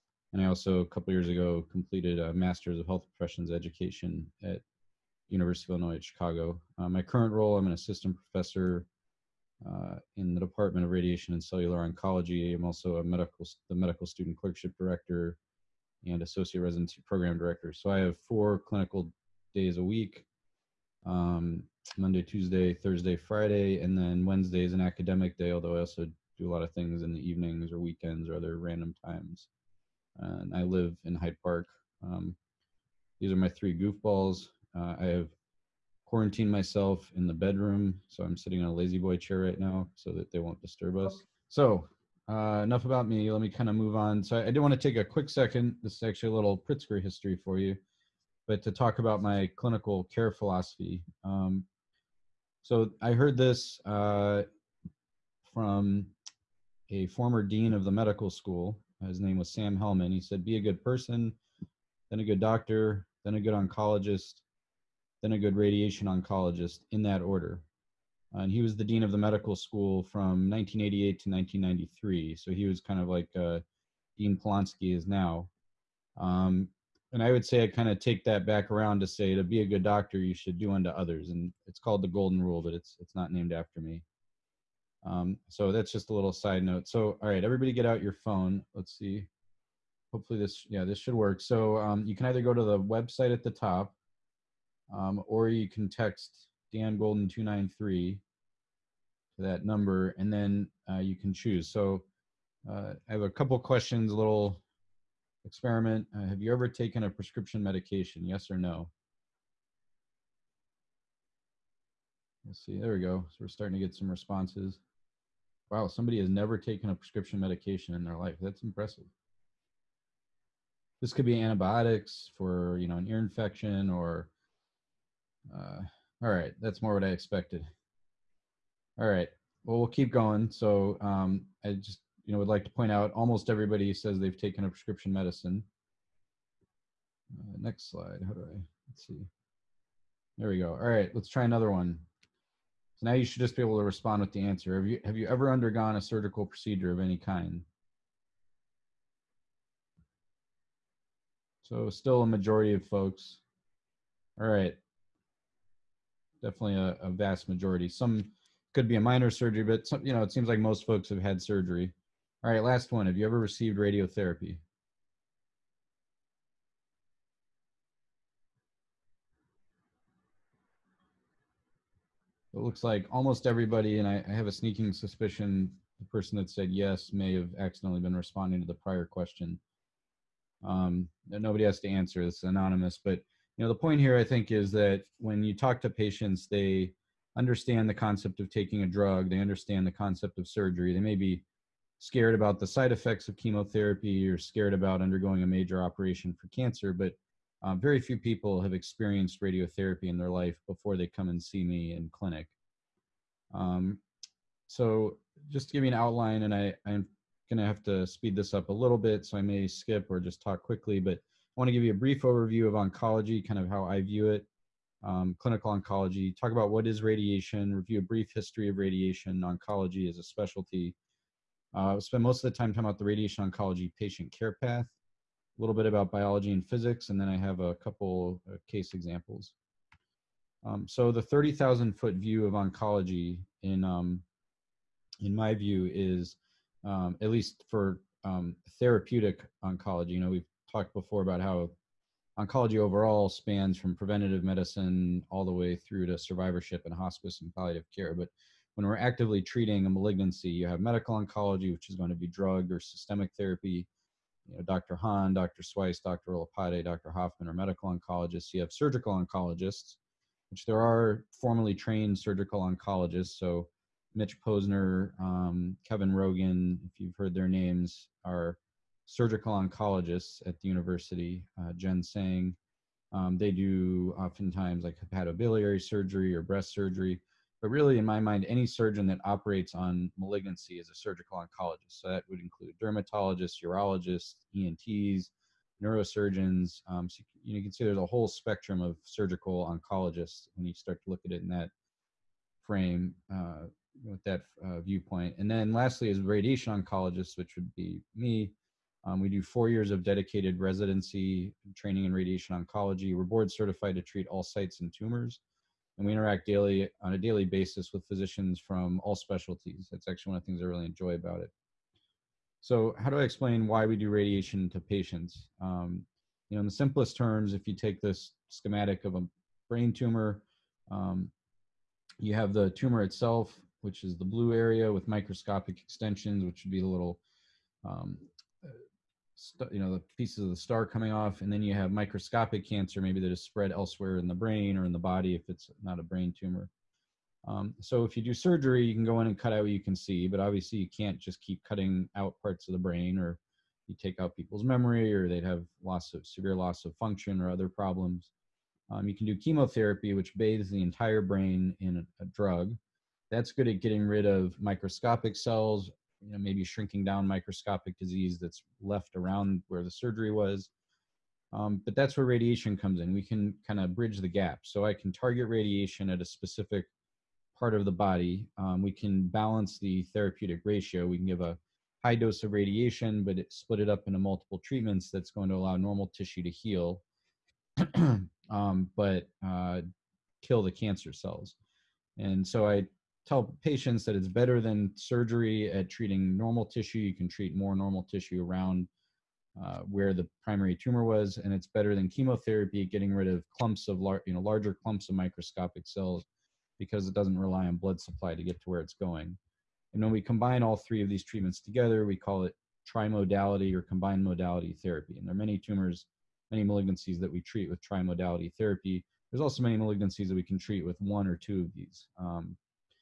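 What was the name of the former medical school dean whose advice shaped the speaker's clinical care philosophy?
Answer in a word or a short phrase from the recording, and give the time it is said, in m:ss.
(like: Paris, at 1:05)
Sam Hellman, at 0:59.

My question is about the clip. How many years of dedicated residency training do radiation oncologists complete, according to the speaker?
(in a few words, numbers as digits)
4.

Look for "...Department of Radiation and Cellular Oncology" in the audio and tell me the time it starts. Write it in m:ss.
0:10.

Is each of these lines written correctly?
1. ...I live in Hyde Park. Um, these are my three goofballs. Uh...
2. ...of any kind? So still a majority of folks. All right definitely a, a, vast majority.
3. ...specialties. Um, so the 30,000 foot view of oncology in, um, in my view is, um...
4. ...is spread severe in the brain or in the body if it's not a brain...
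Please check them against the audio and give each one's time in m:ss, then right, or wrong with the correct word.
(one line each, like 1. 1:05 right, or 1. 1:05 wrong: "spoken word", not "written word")
1. 0:30 right
2. 2:26 right
3. 3:48 wrong: "examples", not "specialties"
4. 5:33 wrong: "elsewhere", not "severe".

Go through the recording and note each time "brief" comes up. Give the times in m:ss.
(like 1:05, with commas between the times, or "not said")
3:31, 3:38.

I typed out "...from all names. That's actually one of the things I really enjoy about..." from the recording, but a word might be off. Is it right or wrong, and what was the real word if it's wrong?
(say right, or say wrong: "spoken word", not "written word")
wrong: "specialties", not "names".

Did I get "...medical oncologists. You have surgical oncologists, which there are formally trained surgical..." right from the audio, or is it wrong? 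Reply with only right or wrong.
right.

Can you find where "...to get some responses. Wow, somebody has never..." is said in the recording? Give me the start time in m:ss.
1:53.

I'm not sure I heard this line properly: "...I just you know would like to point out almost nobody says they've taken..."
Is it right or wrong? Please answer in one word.
wrong.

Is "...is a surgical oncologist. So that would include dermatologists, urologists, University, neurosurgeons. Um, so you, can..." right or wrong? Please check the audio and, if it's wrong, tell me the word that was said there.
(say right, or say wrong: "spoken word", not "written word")
wrong: "ENTs", not "University".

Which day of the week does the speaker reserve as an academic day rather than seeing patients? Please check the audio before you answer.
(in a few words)
Wednesday.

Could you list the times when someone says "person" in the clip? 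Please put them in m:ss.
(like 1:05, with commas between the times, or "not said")
1:00, 2:56.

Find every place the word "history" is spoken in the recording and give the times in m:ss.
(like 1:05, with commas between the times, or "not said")
0:47, 3:38.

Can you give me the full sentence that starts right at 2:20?
All right, let's try another one.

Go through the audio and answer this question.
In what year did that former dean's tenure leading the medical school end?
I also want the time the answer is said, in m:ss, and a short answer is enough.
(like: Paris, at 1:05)
1993, at 1:11.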